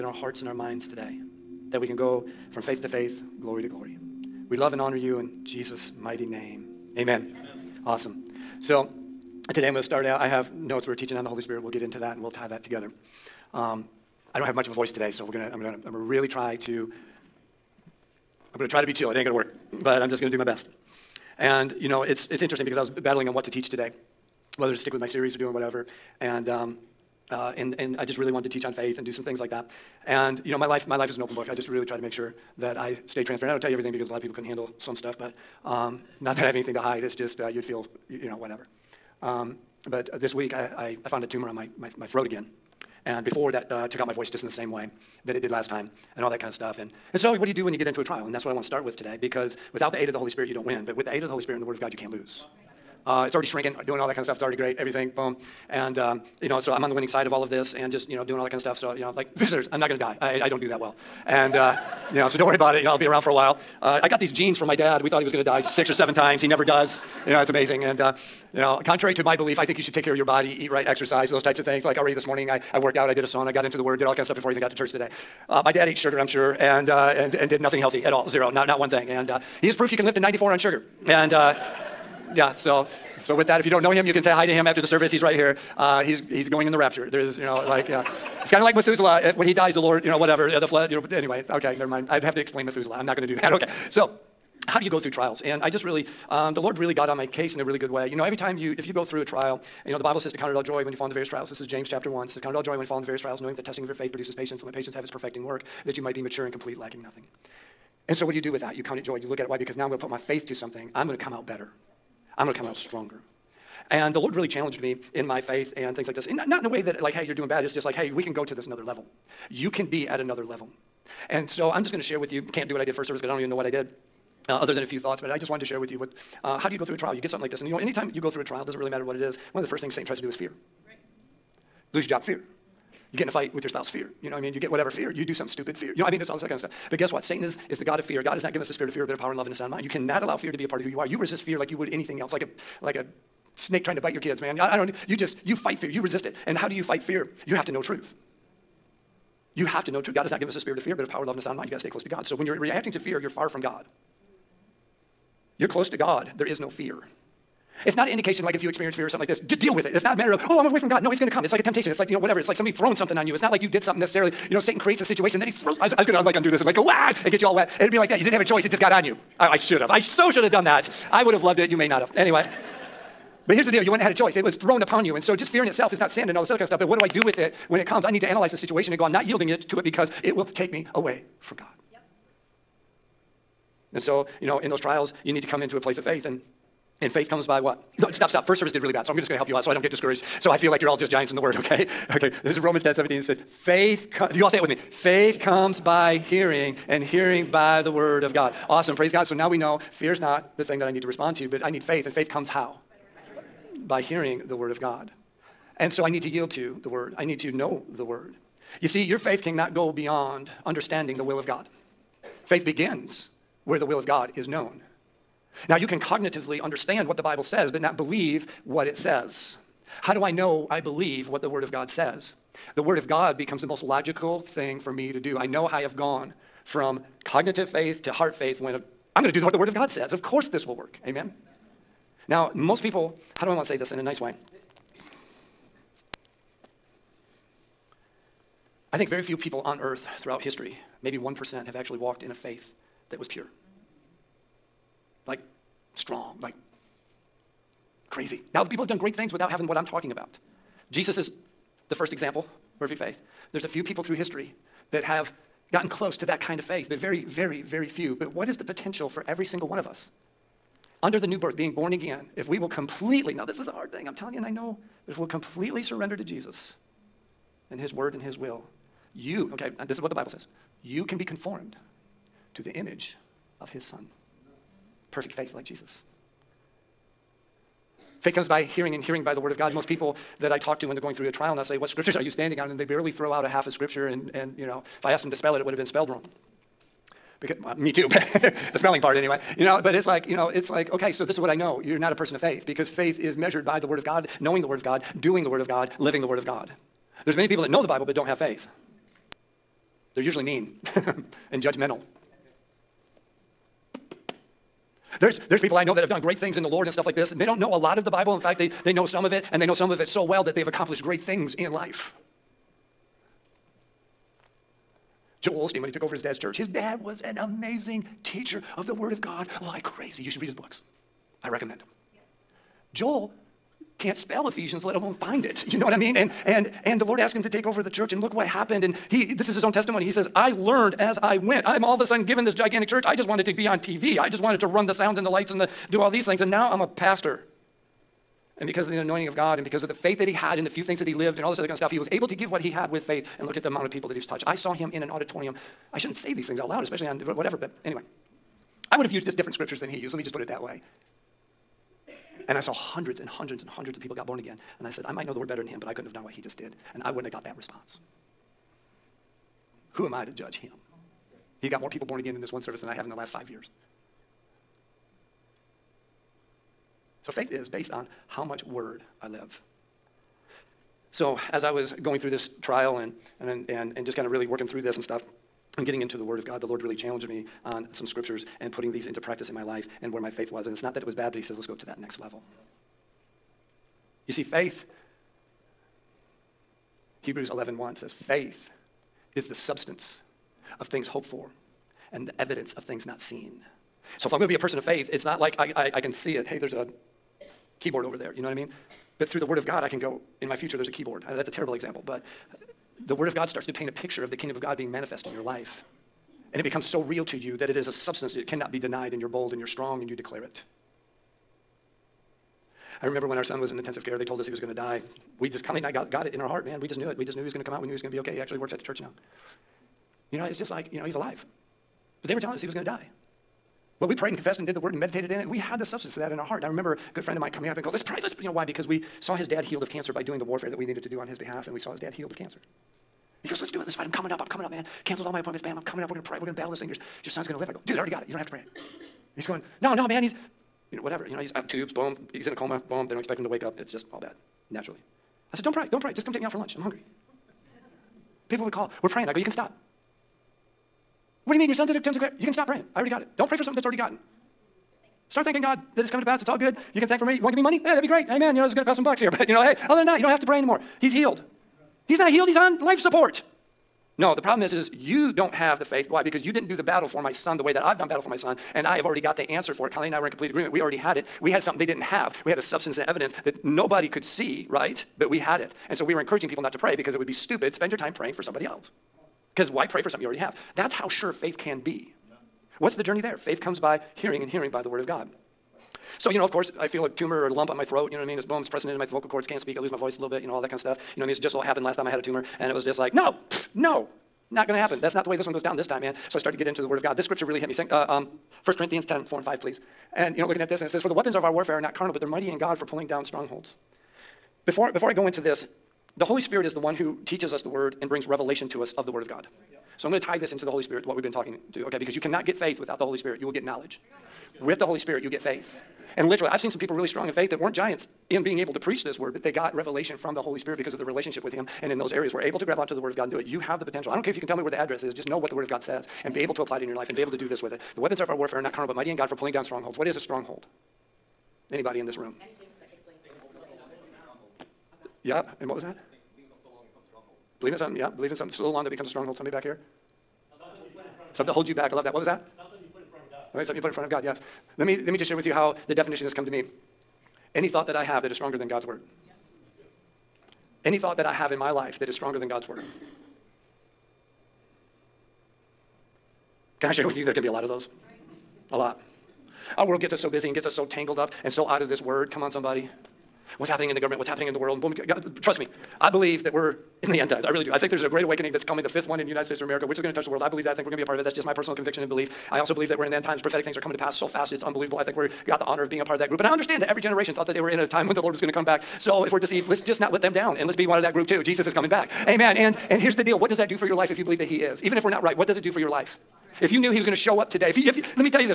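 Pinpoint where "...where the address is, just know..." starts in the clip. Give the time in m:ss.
8:44.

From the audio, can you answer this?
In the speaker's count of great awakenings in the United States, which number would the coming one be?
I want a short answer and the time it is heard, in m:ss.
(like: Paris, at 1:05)
fifth, at 9:28.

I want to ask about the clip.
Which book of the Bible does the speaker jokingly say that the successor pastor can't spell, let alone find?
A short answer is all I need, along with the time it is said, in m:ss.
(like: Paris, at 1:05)
Ephesians, at 5:24.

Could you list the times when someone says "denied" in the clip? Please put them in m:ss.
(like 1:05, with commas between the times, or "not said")
6:48.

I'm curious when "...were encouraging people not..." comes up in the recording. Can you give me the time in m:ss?
7:56.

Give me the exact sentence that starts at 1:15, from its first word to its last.
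Uh, my dad ate sugar, I'm sure, and, uh, and, and did nothing healthy at all, zero, not, not one thing.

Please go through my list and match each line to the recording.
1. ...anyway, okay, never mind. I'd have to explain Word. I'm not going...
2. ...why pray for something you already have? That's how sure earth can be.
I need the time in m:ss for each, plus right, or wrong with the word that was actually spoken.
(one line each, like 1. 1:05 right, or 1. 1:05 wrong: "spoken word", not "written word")
1. 1:31 wrong: "Methuselah", not "Word"
2. 7:59 wrong: "faith", not "earth".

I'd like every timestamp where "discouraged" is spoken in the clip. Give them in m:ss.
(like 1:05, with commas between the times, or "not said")
3:09.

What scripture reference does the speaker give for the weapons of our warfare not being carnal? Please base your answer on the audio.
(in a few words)
1 Corinthians 10:4-5.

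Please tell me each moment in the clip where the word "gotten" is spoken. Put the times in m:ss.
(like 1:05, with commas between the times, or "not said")
4:15, 7:33.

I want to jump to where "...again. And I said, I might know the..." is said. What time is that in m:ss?
5:54.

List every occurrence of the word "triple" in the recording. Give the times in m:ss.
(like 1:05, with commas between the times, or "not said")
not said.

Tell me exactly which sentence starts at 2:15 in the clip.
You know, I mean, it's all this kind of stuff.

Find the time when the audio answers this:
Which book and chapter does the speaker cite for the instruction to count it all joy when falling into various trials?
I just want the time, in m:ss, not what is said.
1:41.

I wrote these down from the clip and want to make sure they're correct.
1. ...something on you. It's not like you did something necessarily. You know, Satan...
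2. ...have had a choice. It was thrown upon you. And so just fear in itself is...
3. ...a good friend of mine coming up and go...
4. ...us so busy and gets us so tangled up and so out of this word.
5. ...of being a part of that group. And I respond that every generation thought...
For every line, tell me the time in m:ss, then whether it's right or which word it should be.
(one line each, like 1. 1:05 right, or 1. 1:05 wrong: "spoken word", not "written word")
1. 2:42 right
2. 2:54 right
3. 7:06 right
4. 9:20 right
5. 9:35 wrong: "understand", not "respond".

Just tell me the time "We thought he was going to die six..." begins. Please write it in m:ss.
1:05.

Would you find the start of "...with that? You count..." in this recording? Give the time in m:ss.
1:48.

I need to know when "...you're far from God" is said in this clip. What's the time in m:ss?
2:33.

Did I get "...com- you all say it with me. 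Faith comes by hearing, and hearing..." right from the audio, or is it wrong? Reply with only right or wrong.
right.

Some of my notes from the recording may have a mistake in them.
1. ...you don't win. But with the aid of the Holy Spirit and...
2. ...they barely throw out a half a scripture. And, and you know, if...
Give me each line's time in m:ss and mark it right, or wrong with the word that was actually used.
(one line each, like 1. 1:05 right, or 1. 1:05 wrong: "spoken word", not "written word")
1. 0:50 right
2. 4:42 right.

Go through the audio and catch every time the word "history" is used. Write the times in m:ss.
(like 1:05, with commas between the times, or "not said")
4:00, 4:14.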